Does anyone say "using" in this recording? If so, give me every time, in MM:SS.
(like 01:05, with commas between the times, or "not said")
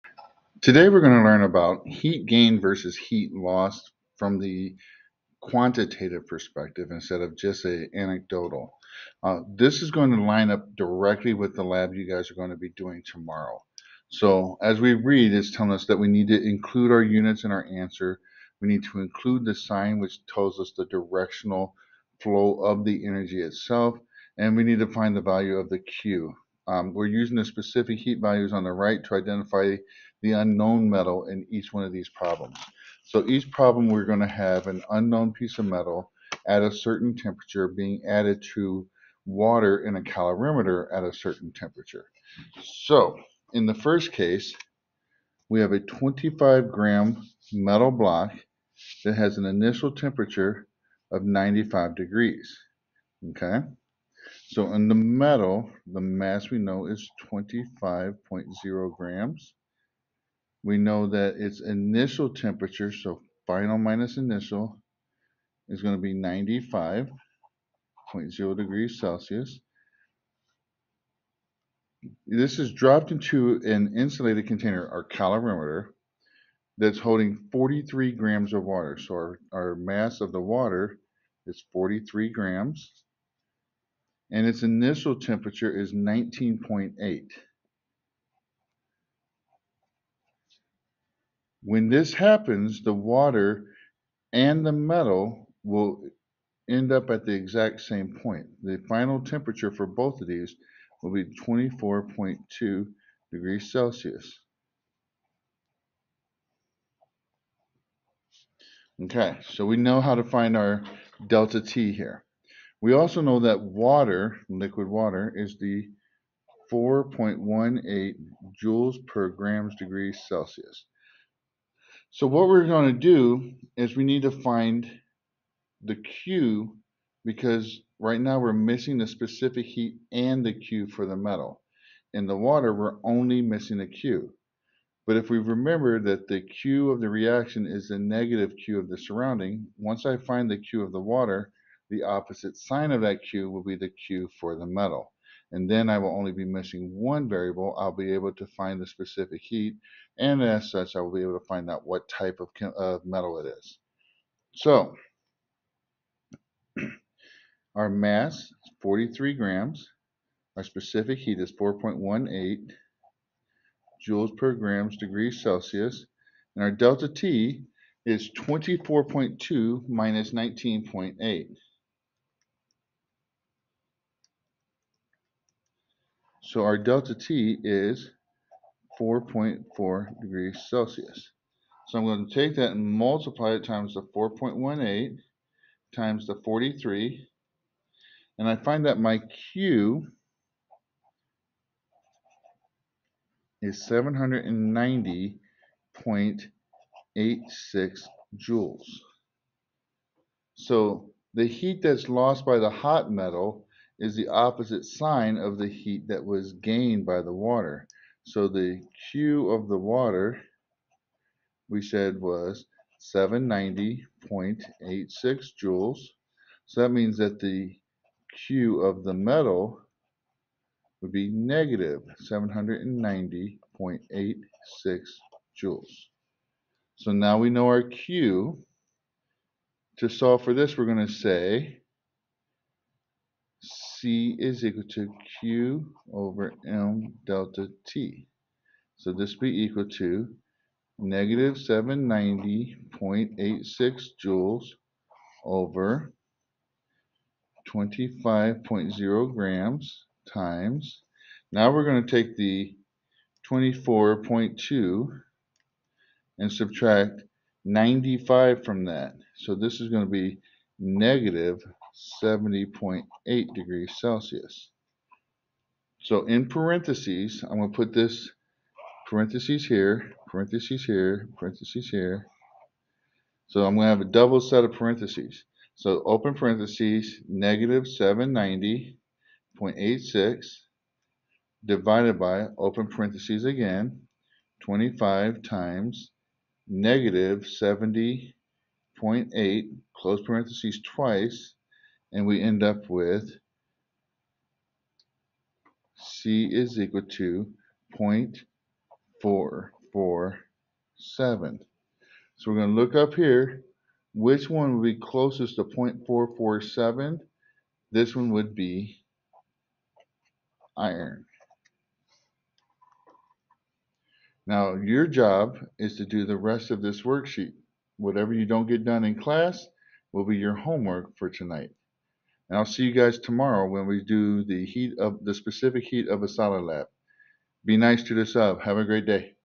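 00:27.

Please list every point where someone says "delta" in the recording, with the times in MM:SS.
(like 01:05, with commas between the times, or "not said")
01:51, 02:46, 02:56, 03:57.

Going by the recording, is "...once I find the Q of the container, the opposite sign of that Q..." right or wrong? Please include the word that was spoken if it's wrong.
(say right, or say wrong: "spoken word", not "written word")
wrong: "water", not "container".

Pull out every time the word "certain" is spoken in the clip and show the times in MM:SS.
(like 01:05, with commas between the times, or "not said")
00:36, 00:41.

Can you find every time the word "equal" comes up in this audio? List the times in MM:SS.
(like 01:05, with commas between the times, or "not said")
03:54, 03:59, 04:56.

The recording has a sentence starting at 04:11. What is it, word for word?
Now we're going to take the 24.2 and subtract 95 from that.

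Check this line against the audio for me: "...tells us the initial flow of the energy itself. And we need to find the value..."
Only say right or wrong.
wrong.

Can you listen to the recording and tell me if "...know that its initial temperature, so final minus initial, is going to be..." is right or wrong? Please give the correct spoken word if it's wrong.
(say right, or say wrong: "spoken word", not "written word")
right.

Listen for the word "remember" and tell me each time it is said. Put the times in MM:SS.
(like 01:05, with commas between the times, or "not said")
02:15.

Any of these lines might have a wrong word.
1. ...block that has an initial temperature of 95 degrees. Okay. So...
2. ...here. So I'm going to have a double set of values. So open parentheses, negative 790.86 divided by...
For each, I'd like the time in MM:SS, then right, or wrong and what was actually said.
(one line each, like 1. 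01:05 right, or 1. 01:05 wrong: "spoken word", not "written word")
1. 00:47 right
2. 04:31 wrong: "parentheses", not "values".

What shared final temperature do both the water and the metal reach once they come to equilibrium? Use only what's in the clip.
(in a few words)
24.2 degrees Celsius.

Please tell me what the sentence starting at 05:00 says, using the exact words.
So we're going to look up here, which one would be closest to 0.447?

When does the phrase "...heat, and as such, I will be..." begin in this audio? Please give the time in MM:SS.
02:29.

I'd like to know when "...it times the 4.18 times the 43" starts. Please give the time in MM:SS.
03:03.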